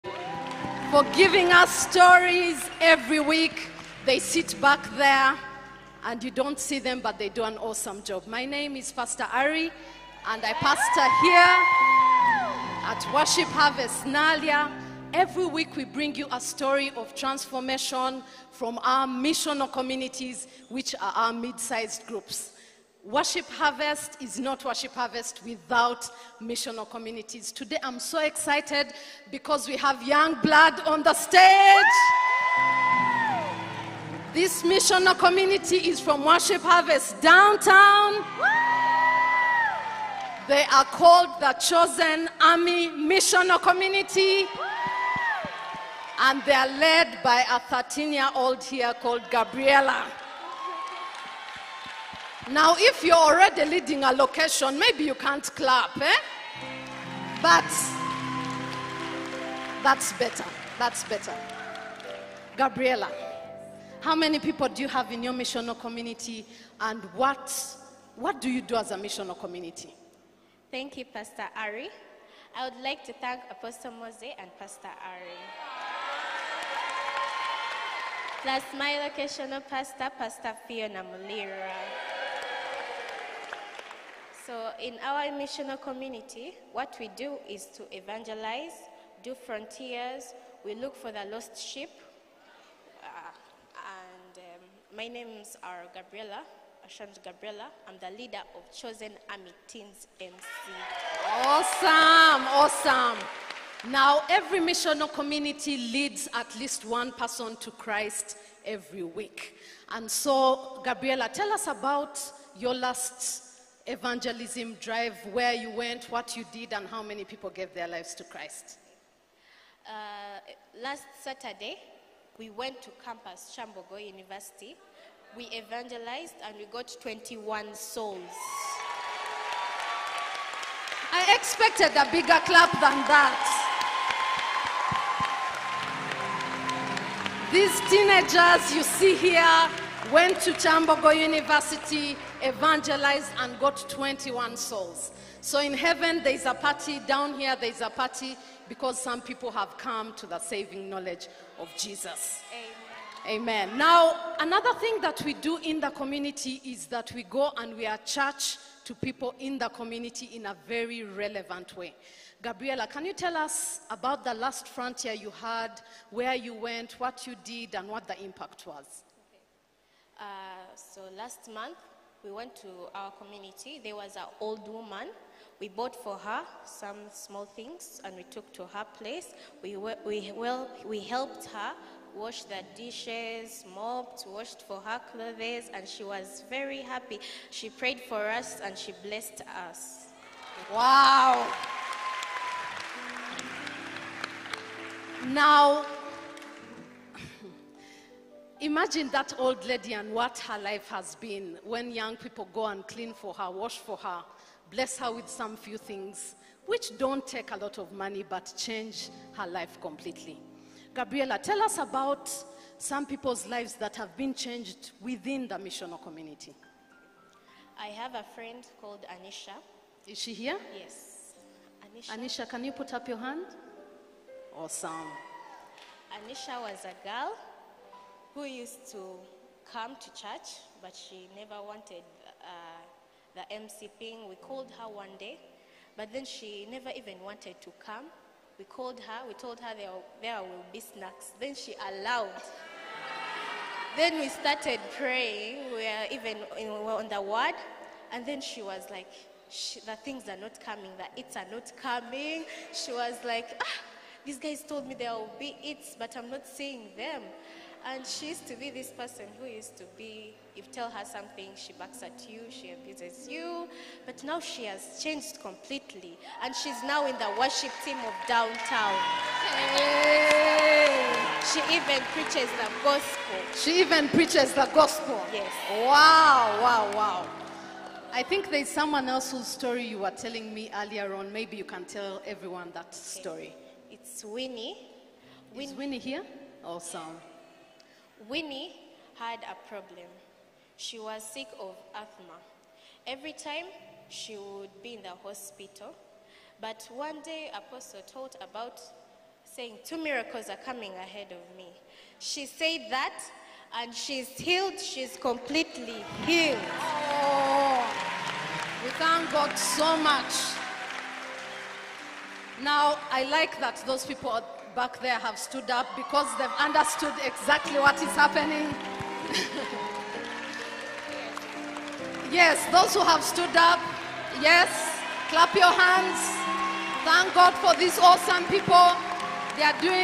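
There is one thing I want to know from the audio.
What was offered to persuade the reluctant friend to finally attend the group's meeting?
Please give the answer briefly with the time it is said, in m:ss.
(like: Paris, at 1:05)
Snacks, at 4:00.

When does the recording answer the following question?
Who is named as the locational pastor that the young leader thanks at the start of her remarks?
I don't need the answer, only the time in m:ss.
1:20.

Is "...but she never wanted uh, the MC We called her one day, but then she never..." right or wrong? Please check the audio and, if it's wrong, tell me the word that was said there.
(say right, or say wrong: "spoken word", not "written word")
right.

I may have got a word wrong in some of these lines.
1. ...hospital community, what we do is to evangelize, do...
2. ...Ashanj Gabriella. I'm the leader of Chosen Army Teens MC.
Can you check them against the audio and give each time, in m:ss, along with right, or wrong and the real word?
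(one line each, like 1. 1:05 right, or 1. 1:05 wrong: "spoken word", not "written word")
1. 1:25 wrong: "missional", not "hospital"
2. 1:36 right.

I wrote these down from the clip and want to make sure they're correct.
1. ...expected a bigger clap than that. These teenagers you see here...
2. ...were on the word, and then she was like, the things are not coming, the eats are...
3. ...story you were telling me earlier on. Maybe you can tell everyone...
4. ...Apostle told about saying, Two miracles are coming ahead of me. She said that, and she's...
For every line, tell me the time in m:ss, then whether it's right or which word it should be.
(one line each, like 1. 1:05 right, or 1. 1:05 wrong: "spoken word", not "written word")
1. 2:11 right
2. 4:06 right
3. 4:39 right
4. 4:57 right.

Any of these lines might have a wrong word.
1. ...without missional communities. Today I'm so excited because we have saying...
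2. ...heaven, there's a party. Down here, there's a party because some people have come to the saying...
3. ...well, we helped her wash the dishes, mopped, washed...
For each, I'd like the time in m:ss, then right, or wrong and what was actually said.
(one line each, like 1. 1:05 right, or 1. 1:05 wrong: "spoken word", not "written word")
1. 0:25 wrong: "young", not "saying"
2. 2:25 wrong: "saving", not "saying"
3. 3:00 right.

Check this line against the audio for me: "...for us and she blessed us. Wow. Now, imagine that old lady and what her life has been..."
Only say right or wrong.
right.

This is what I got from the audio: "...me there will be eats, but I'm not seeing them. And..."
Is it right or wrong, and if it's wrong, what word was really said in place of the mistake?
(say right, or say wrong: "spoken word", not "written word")
right.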